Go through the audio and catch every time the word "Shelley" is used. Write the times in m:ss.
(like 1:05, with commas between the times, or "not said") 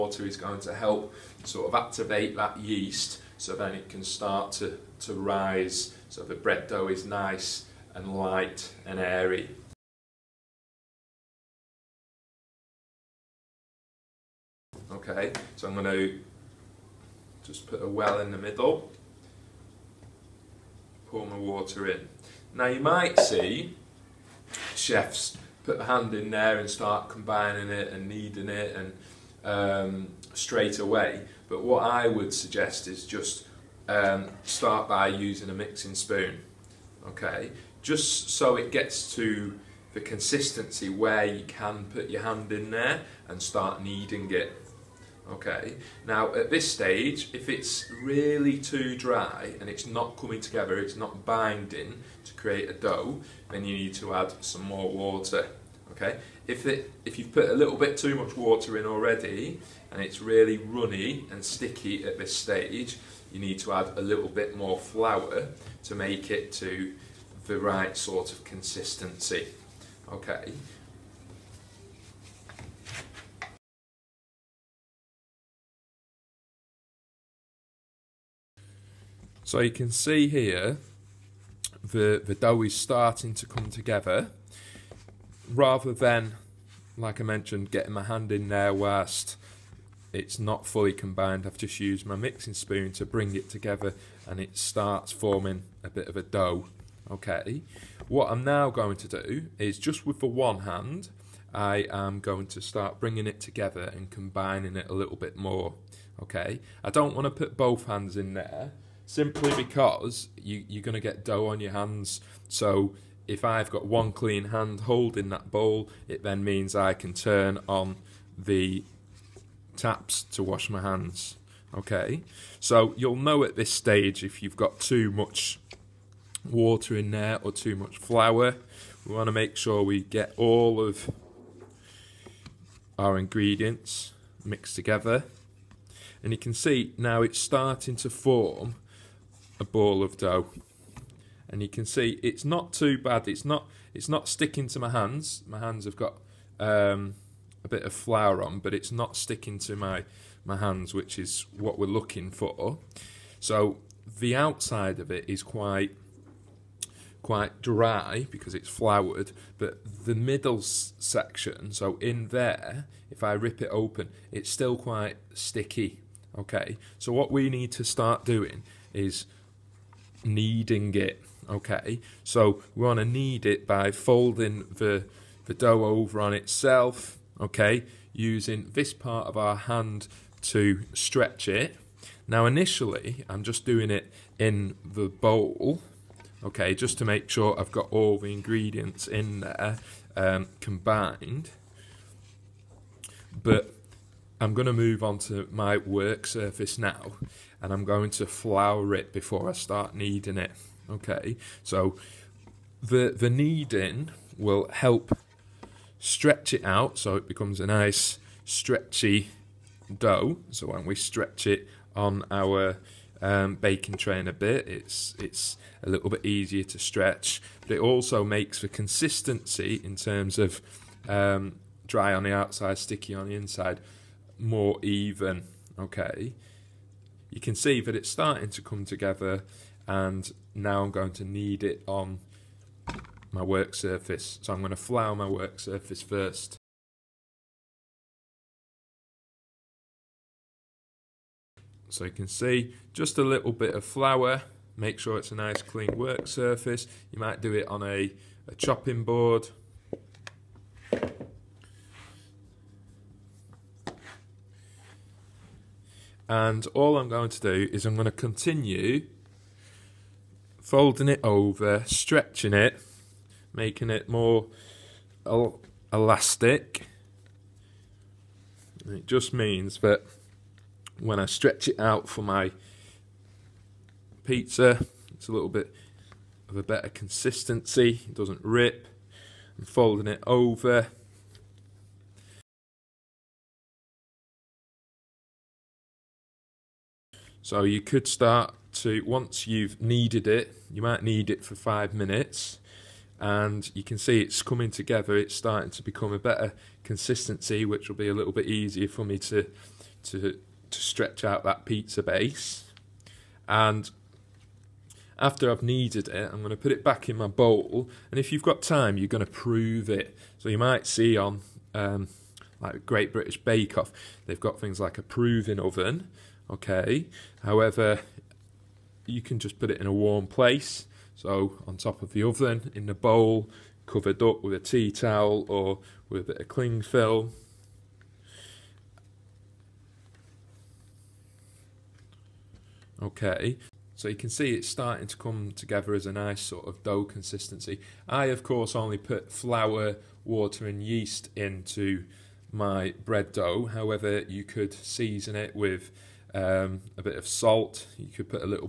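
not said.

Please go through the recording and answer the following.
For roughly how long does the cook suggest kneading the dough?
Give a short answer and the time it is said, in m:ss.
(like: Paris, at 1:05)
5 minutes, at 4:51.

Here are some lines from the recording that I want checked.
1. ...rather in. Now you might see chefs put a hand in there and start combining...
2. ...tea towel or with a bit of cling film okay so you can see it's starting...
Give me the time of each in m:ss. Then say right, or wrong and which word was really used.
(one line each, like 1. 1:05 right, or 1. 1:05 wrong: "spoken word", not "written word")
1. 0:21 wrong: "water", not "rather"
2. 5:24 right.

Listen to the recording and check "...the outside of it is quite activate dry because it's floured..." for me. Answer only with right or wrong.
wrong.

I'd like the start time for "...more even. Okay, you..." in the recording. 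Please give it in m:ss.
3:44.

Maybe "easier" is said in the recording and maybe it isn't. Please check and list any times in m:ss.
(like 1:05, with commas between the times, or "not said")
3:36, 4:58.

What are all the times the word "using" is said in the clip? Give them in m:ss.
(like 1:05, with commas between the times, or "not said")
0:35, 2:58.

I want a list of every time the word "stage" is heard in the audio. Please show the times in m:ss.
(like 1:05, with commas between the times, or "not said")
0:46, 1:02, 2:03.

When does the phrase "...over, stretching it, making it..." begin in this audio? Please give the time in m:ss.
4:21.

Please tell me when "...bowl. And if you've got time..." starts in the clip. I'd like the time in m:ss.
5:07.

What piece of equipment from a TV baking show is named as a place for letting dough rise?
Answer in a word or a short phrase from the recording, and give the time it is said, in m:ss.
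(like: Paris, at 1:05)
proving oven, at 5:15.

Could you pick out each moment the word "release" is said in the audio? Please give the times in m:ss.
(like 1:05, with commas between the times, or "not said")
not said.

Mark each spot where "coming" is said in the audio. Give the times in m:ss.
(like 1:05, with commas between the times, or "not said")
0:50, 4:54.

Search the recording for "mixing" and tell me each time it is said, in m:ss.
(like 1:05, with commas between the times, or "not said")
0:35, 1:32.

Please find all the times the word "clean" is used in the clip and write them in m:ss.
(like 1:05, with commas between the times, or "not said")
1:54, 4:05.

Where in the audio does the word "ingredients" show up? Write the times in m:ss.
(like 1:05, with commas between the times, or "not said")
2:13, 3:08.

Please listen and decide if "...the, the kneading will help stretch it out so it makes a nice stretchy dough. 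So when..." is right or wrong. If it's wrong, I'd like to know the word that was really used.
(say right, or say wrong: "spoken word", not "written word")
wrong: "becomes", not "makes".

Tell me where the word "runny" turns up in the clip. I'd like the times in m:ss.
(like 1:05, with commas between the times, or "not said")
1:00.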